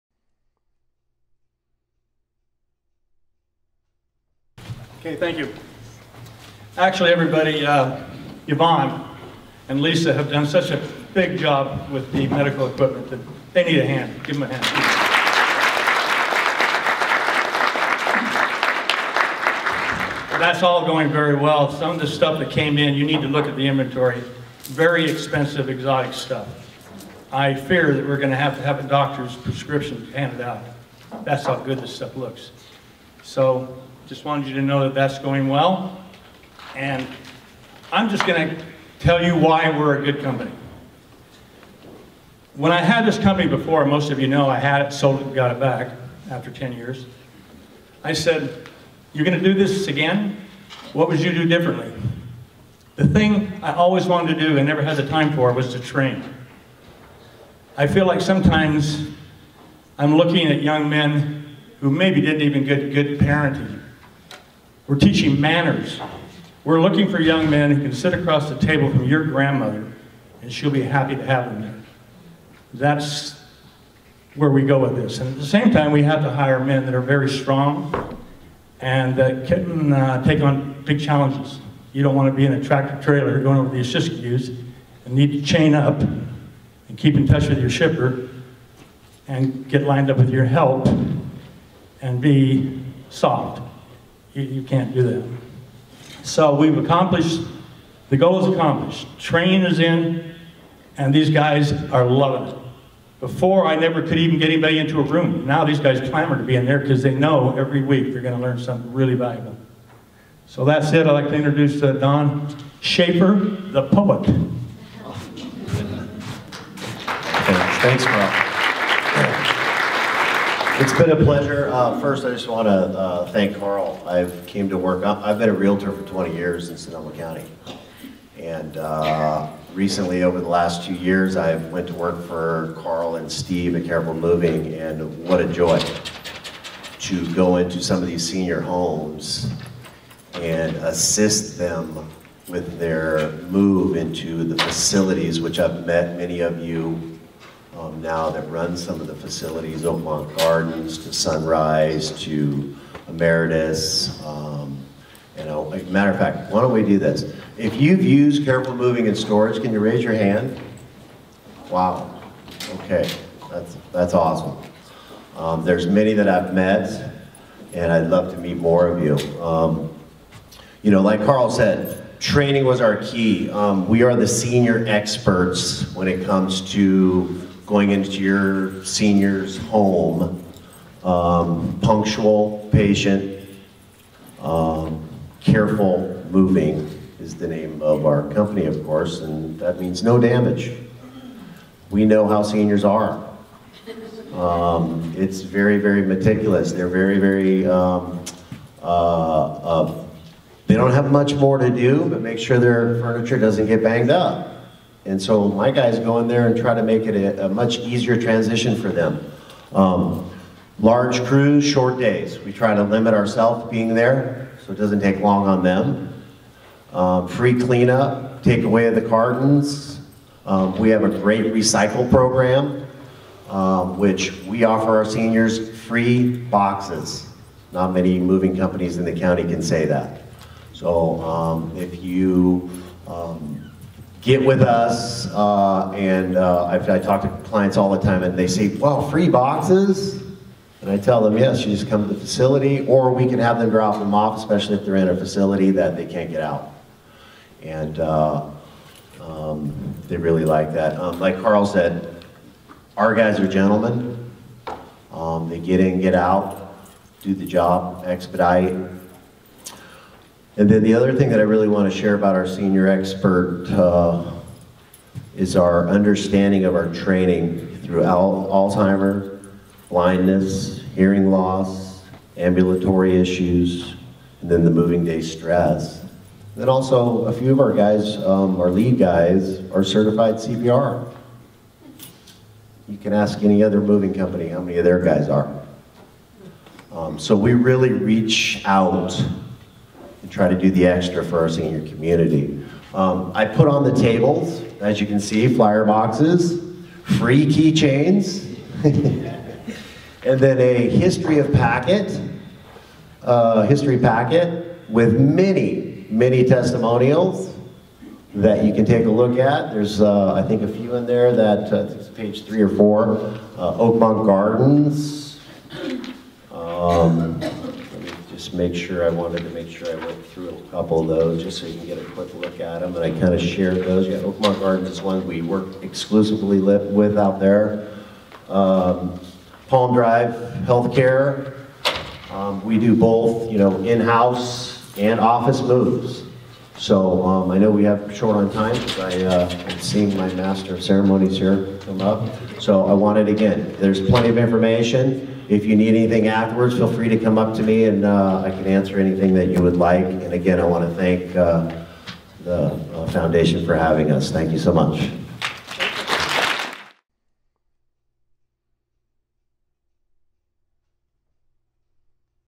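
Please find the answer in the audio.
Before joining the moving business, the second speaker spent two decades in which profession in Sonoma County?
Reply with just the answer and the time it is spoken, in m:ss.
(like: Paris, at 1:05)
realtor, at 2:05.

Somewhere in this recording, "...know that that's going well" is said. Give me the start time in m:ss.
0:34.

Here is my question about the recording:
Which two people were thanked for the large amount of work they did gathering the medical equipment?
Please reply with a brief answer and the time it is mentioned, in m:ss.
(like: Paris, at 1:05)
Yvonne and Lisa, at 0:08.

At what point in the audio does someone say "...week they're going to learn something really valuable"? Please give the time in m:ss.
1:47.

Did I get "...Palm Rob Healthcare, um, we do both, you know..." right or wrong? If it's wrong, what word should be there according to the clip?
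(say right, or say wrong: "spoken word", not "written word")
wrong: "Drive", not "Rob".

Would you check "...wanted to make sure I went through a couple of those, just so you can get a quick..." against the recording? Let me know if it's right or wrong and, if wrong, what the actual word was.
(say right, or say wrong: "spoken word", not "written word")
right.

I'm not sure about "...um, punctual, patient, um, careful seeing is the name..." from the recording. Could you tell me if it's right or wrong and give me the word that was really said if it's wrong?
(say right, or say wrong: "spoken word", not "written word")
wrong: "moving", not "seeing".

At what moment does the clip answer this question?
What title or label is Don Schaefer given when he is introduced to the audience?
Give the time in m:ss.
1:53.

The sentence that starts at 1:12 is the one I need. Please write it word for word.
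That's where we go with this.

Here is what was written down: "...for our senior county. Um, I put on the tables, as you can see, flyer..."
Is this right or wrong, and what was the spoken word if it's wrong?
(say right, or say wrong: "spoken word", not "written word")
wrong: "community", not "county".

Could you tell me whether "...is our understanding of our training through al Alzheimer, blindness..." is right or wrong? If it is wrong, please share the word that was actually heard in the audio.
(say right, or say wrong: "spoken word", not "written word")
right.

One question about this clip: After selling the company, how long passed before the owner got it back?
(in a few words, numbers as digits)
10 years.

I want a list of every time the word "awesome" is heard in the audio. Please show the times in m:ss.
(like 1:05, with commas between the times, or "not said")
2:44.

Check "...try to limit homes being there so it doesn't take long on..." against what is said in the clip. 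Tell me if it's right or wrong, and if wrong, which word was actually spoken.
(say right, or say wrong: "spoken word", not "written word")
wrong: "ourselves", not "homes".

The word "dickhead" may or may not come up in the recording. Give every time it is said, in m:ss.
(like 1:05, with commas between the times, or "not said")
not said.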